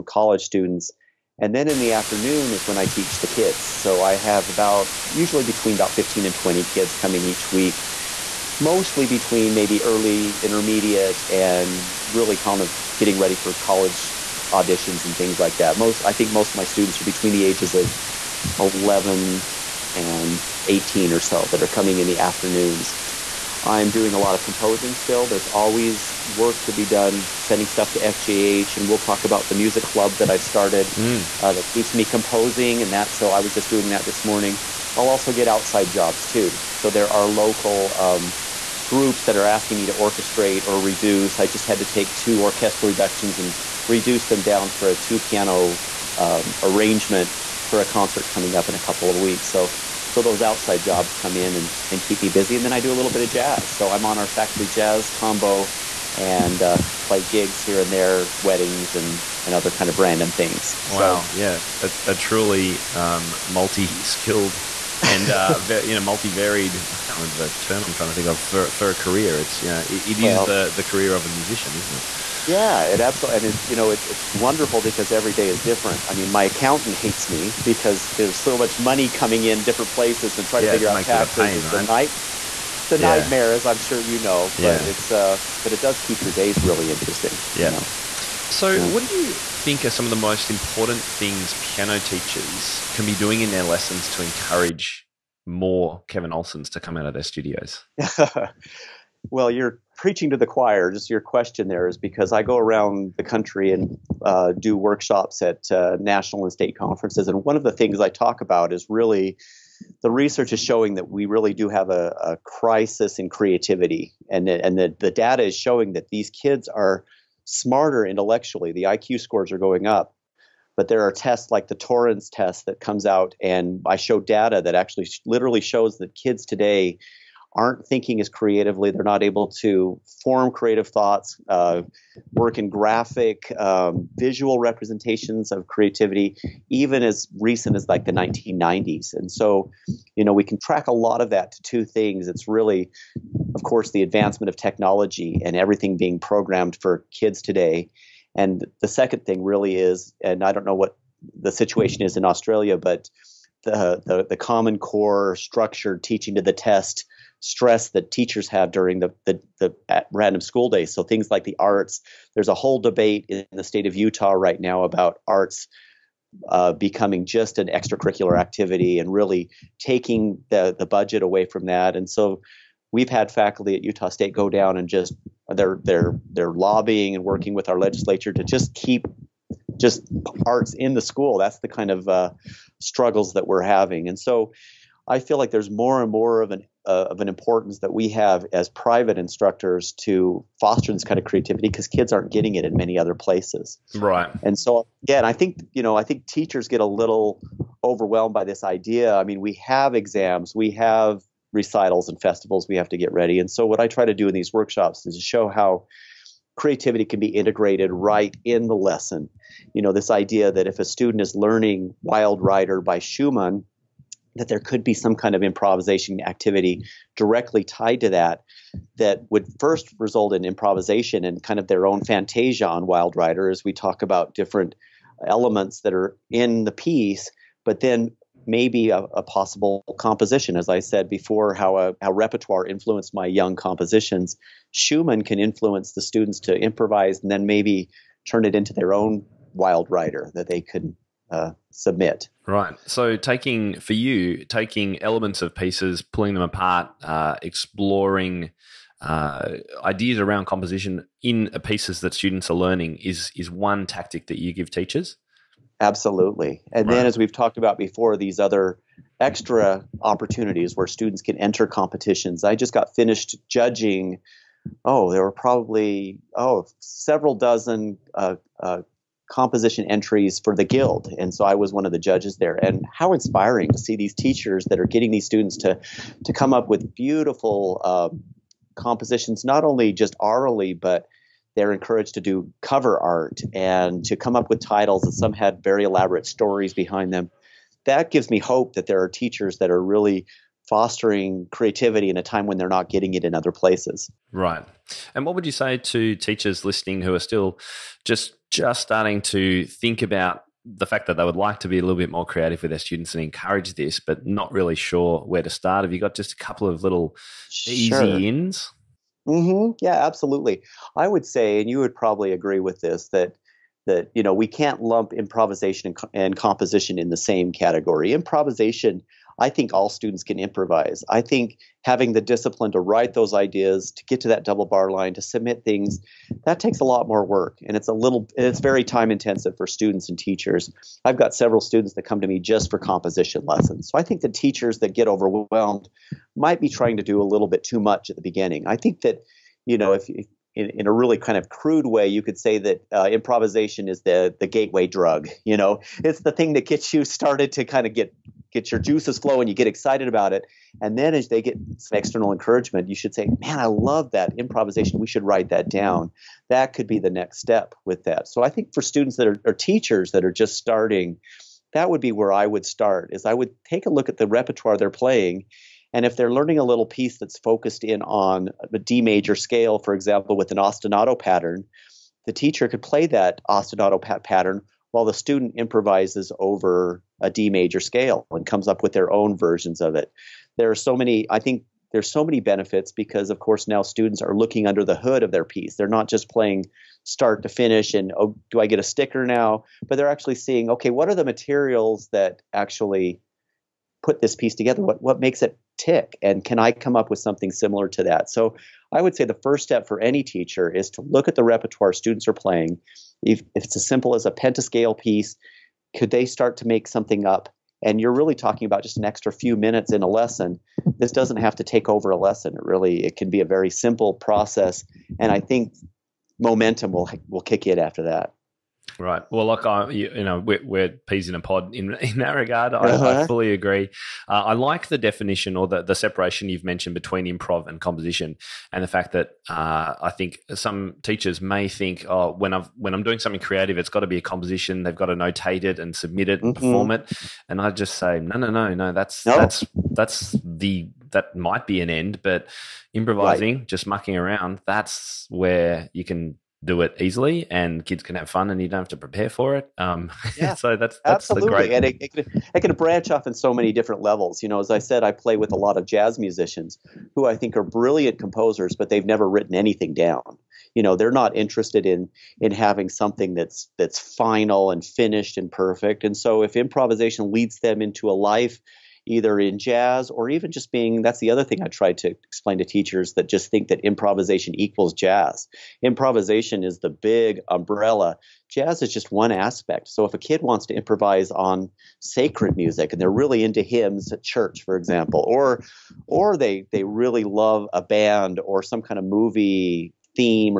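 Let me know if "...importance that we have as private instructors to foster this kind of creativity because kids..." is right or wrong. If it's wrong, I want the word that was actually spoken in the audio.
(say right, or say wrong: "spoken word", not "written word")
right.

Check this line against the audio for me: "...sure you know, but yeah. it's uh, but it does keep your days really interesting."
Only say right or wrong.
right.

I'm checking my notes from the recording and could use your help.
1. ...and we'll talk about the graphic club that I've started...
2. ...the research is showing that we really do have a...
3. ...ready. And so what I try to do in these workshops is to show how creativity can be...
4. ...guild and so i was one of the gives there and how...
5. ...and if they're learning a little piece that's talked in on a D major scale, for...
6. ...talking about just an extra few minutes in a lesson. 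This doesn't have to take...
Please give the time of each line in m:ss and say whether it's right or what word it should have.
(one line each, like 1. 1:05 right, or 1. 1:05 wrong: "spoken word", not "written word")
1. 0:28 wrong: "music", not "graphic"
2. 1:50 right
3. 3:23 right
4. 4:30 wrong: "judges", not "gives"
5. 6:05 wrong: "focused", not "talked"
6. 6:48 right.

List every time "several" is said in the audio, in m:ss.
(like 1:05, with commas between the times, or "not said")
4:26, 5:31.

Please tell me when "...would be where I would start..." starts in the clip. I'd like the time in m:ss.
6:01.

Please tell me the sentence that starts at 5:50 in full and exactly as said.
And then as they get some external encouragement, you should say, Man, I love that improvisation.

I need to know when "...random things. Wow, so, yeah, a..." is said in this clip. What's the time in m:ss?
0:59.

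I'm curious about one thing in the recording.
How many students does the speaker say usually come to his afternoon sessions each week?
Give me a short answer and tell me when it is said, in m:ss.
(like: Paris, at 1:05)
15 to 20, at 0:05.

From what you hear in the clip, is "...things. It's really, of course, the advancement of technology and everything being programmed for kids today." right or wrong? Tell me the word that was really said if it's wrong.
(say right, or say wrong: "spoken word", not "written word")
right.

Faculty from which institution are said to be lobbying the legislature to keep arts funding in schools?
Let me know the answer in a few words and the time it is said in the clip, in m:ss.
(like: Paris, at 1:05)
Utah State, at 2:53.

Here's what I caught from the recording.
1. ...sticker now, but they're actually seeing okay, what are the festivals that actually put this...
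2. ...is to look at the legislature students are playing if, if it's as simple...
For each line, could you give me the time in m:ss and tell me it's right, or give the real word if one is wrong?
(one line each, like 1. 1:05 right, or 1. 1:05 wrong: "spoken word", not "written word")
1. 6:28 wrong: "materials", not "festivals"
2. 6:40 wrong: "repertoire", not "legislature".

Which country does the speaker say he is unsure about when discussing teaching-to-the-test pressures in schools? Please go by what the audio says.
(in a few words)
Australia.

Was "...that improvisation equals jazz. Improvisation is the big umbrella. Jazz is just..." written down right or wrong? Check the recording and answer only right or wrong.
right.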